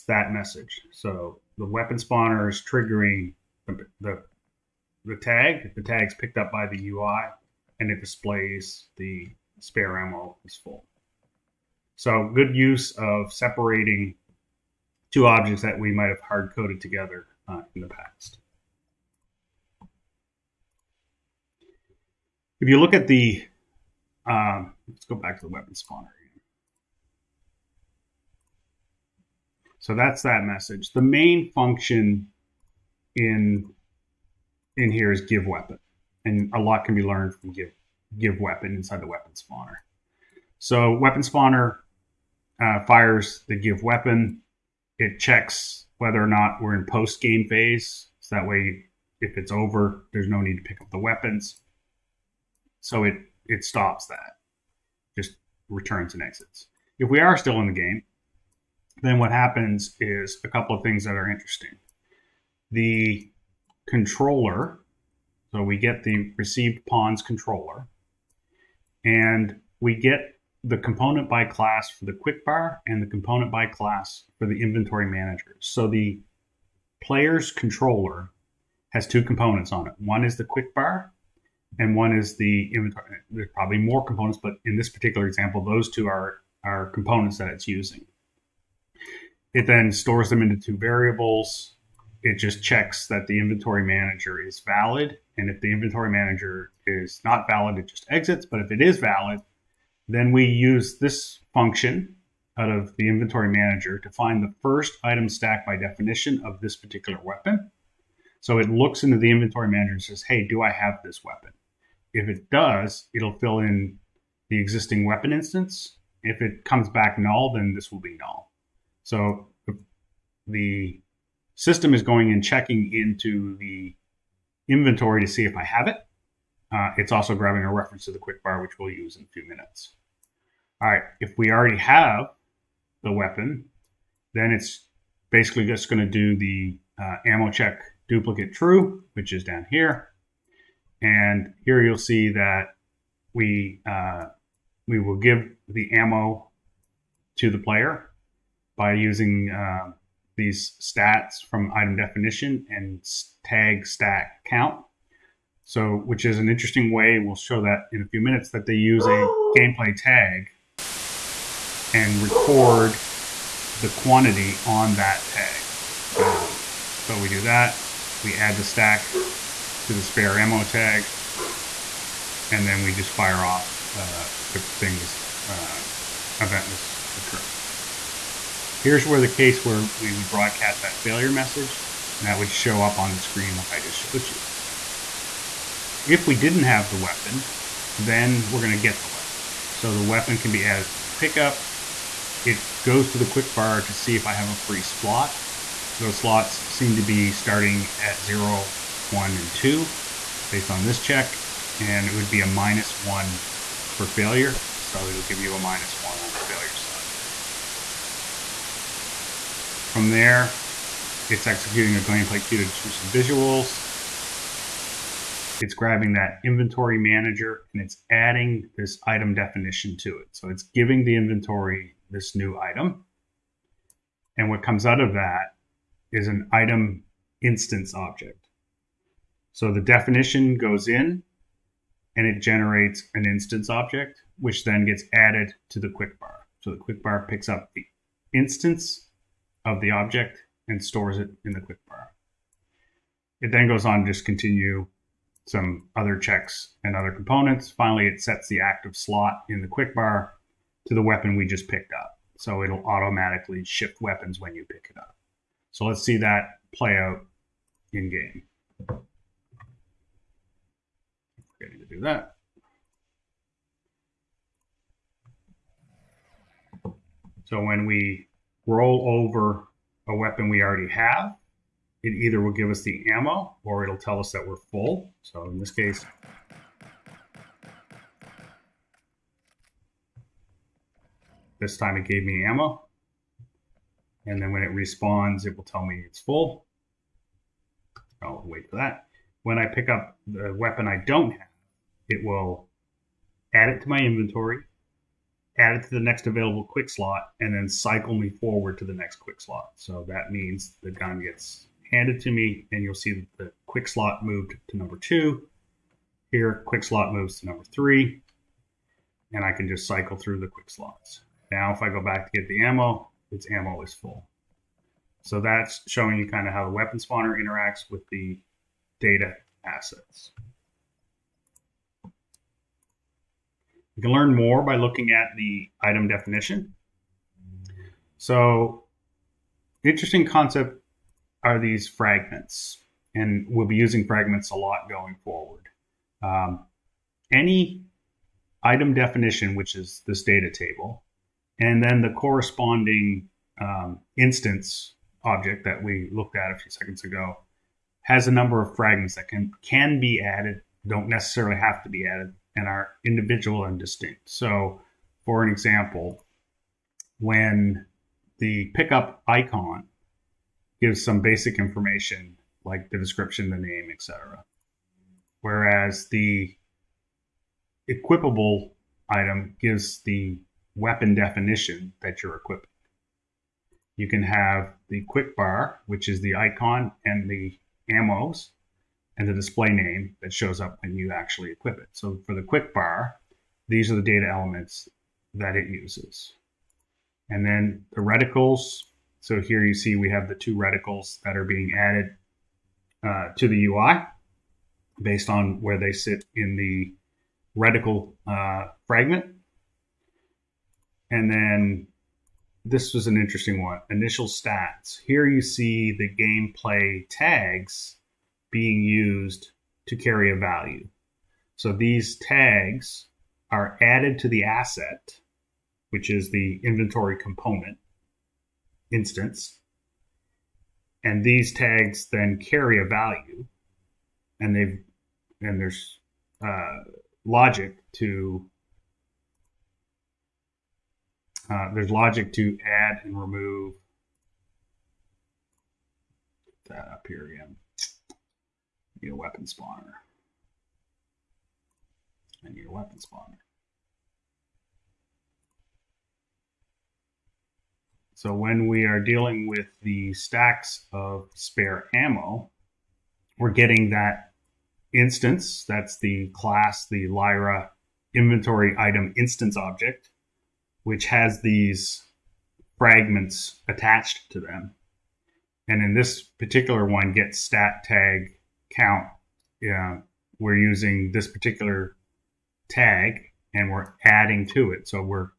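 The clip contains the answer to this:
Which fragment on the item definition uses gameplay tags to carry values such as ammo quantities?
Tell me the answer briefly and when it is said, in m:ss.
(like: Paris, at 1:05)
Initial stats, at 6:43.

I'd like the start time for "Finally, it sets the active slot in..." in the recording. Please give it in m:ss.
4:07.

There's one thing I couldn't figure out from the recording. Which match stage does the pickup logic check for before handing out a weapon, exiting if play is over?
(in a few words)
Post game phase.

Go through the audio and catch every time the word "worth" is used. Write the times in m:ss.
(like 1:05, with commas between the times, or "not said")
not said.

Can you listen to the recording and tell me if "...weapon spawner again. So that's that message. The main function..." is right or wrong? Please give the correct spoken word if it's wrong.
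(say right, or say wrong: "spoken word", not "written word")
right.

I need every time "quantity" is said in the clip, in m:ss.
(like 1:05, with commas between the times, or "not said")
2:43.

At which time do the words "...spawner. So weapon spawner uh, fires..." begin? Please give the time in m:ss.
0:39.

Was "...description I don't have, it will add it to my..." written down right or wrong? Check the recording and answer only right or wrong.
wrong.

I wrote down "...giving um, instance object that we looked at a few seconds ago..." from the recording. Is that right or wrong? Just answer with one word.
wrong.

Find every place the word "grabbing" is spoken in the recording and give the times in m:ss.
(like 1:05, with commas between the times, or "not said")
2:07, 3:35.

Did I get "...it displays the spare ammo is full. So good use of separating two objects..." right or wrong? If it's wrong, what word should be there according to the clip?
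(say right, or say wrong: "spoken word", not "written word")
right.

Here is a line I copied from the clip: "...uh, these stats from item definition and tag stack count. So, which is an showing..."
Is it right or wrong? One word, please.
wrong.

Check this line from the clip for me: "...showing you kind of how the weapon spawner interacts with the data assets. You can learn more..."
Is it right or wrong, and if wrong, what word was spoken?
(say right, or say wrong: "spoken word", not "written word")
right.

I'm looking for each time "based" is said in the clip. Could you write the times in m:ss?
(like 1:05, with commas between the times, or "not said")
3:20, 6:35.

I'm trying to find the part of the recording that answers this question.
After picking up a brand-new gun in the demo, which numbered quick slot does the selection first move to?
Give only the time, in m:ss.
5:04.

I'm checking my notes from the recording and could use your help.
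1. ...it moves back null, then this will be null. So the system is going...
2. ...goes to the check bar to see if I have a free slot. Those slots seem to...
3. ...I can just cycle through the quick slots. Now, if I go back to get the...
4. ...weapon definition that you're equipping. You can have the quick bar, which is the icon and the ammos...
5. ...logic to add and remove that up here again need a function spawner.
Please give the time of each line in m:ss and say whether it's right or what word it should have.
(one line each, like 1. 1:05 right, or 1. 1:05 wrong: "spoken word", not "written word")
1. 1:56 wrong: "comes", not "moves"
2. 3:12 wrong: "quick", not "check"
3. 5:09 right
4. 6:10 right
5. 7:11 wrong: "weapon", not "function".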